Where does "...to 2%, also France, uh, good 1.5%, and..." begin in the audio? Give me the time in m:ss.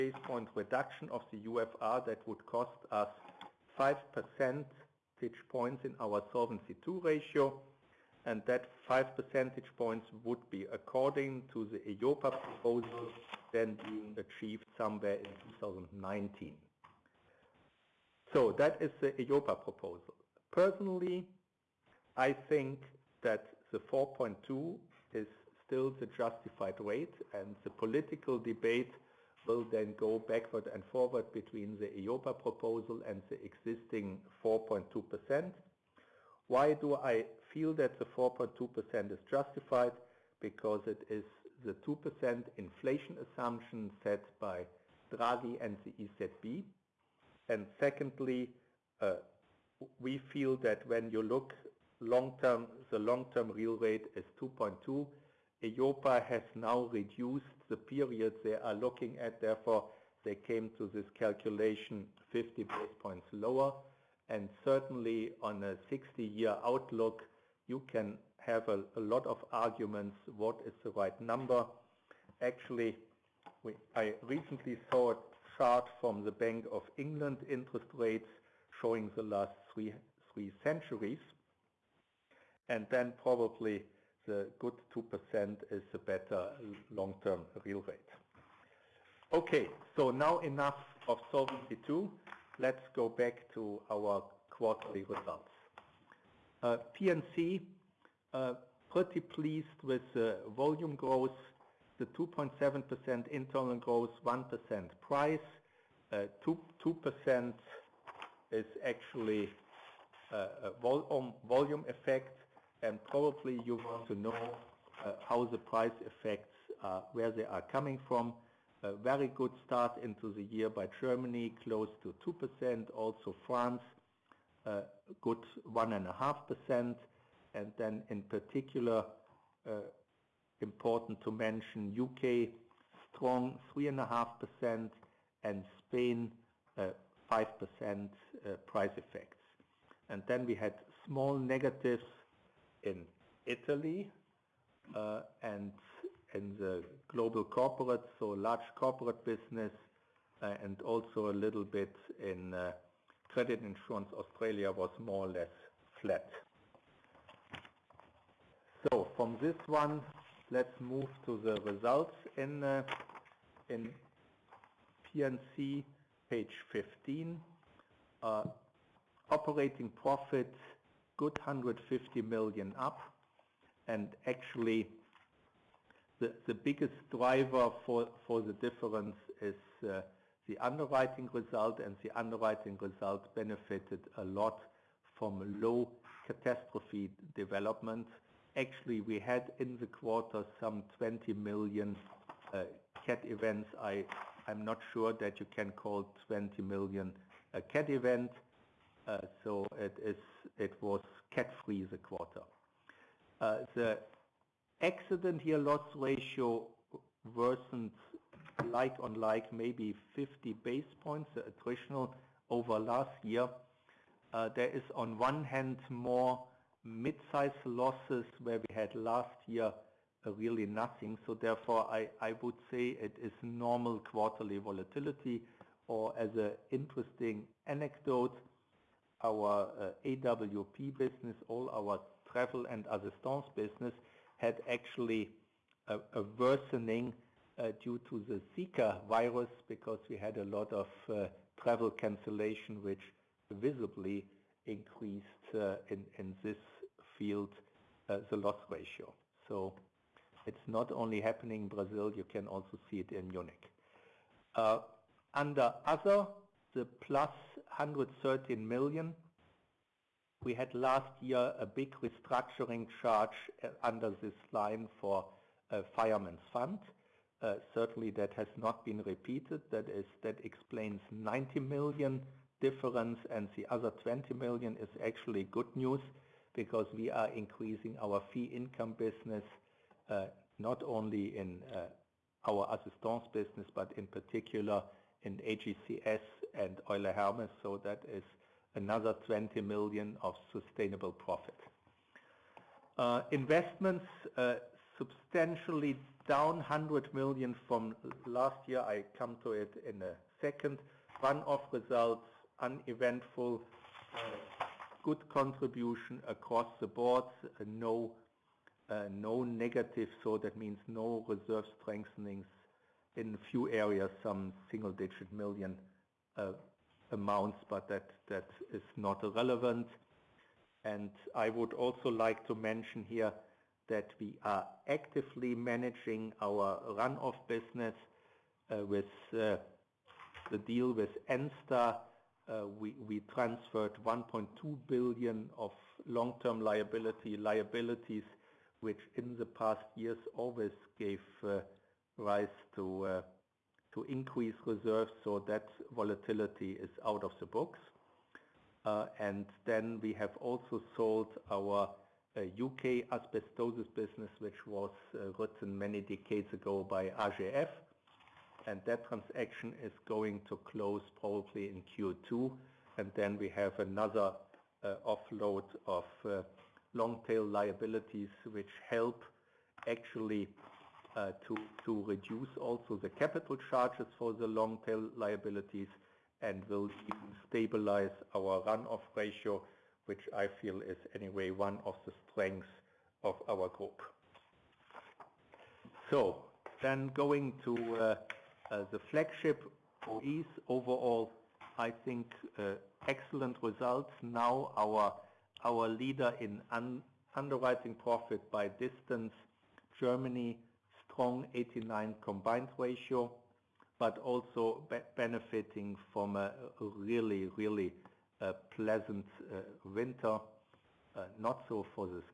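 2:02.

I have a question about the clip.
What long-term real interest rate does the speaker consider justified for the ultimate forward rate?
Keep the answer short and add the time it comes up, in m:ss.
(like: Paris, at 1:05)
2.2, at 0:54.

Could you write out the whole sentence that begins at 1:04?
And certainly on a 60-year outlook, you can have a, lot of arguments what is the right number.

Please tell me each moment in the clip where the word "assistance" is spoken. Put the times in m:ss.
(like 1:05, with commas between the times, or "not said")
3:52, 4:42.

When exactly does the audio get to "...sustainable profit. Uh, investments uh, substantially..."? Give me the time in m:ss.
4:50.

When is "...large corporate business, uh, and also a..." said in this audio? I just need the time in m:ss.
2:28.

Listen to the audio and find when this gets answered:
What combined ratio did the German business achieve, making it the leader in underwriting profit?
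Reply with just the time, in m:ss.
6:41.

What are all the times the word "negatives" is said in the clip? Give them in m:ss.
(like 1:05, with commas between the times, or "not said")
2:21, 5:09.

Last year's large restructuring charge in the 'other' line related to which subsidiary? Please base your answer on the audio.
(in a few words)
Fireman's Fund.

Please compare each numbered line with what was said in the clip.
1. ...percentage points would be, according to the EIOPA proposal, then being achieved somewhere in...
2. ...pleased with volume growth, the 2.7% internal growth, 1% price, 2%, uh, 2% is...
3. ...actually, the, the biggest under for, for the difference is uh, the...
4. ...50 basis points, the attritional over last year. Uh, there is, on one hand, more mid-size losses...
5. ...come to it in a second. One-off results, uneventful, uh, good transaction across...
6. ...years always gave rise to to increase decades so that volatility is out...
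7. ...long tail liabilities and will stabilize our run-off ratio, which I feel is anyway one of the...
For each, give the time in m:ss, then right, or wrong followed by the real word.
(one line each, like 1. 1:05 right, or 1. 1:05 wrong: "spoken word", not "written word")
1. 0:09 right
2. 1:39 right
3. 2:54 wrong: "driver", not "under"
4. 3:30 right
5. 4:59 wrong: "contribution", not "transaction"
6. 5:39 wrong: "reserves", not "decades"
7. 6:14 right.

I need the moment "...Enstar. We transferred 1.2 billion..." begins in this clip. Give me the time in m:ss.
5:31.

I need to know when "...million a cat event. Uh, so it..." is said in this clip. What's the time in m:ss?
3:16.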